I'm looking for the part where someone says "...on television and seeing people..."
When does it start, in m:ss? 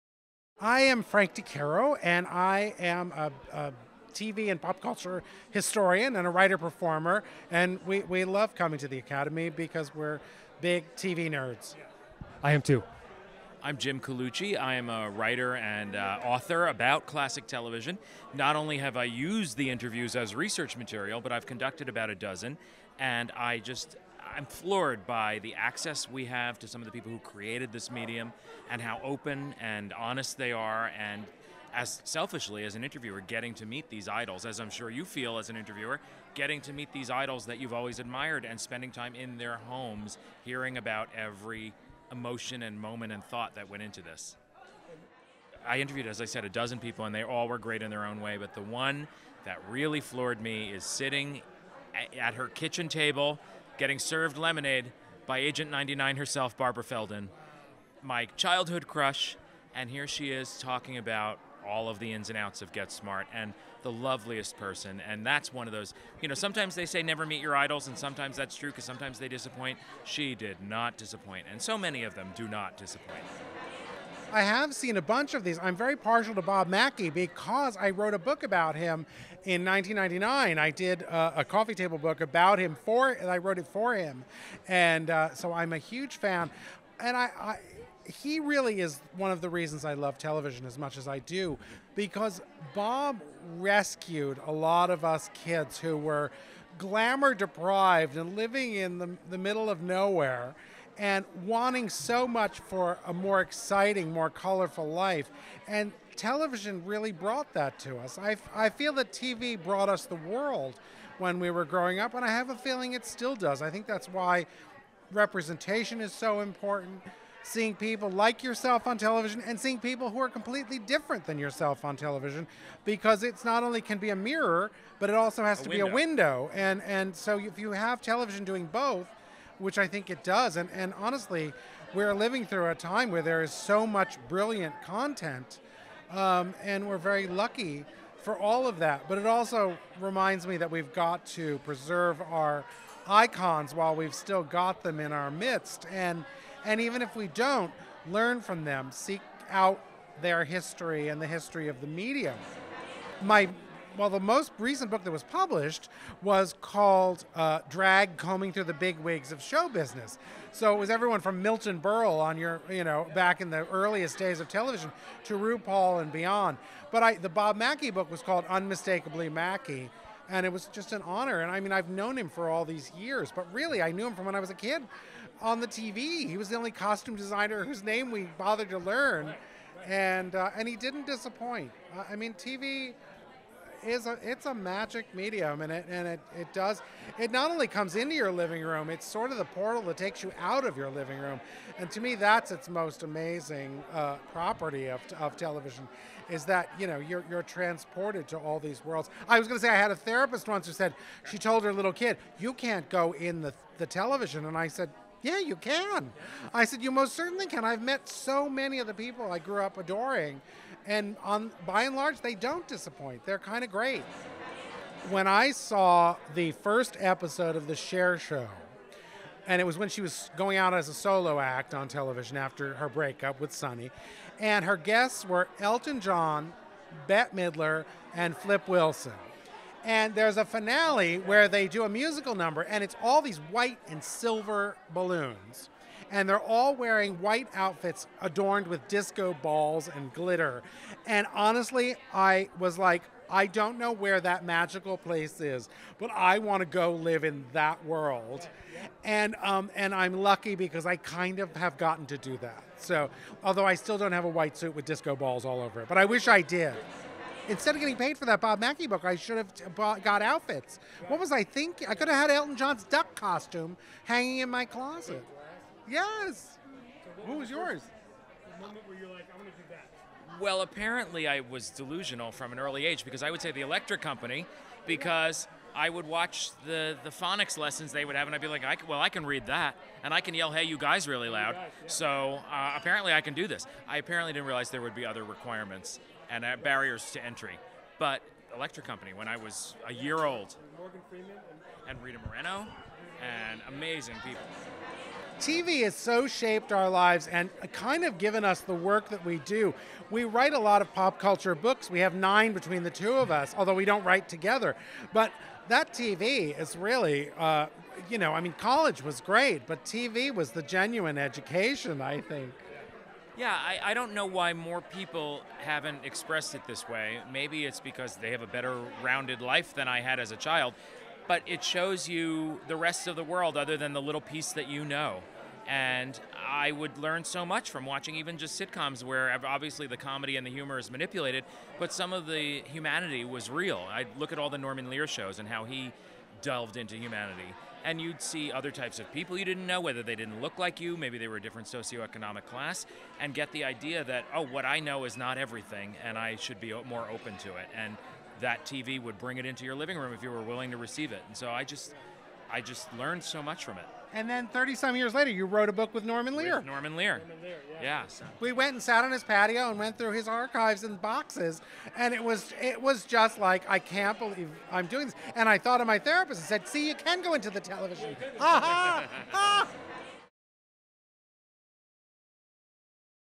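1:58.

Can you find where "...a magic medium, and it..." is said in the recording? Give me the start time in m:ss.
3:04.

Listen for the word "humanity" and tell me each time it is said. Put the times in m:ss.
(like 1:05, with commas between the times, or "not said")
5:32, 5:36.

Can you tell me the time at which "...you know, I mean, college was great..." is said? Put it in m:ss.
5:08.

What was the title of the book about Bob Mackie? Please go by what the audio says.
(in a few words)
Unmistakably Mackie.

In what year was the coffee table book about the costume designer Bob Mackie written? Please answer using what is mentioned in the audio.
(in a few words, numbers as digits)
1999.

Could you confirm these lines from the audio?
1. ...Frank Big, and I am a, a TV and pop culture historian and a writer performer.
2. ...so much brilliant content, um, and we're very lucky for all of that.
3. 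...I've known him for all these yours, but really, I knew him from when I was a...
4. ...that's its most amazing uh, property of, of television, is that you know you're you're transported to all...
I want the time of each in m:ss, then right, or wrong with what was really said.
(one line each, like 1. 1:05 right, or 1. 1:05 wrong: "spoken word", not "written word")
1. 0:01 wrong: "DeCaro", not "Big"
2. 2:13 right
3. 2:51 wrong: "years", not "yours"
4. 3:12 right.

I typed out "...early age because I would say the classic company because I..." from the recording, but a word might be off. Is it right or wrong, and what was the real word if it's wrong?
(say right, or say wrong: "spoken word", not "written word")
wrong: "electric", not "classic".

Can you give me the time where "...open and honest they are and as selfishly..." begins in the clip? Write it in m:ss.
0:29.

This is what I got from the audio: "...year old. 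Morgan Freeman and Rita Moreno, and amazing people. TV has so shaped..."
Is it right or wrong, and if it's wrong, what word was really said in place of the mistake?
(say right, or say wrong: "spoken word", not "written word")
right.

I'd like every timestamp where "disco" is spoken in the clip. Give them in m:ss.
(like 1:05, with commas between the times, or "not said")
3:58, 4:14.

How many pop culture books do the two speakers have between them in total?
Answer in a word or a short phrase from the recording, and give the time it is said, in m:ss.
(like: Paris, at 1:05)
9, at 5:02.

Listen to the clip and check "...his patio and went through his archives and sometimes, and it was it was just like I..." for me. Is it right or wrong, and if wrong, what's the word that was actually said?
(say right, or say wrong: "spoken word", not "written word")
wrong: "boxes", not "sometimes".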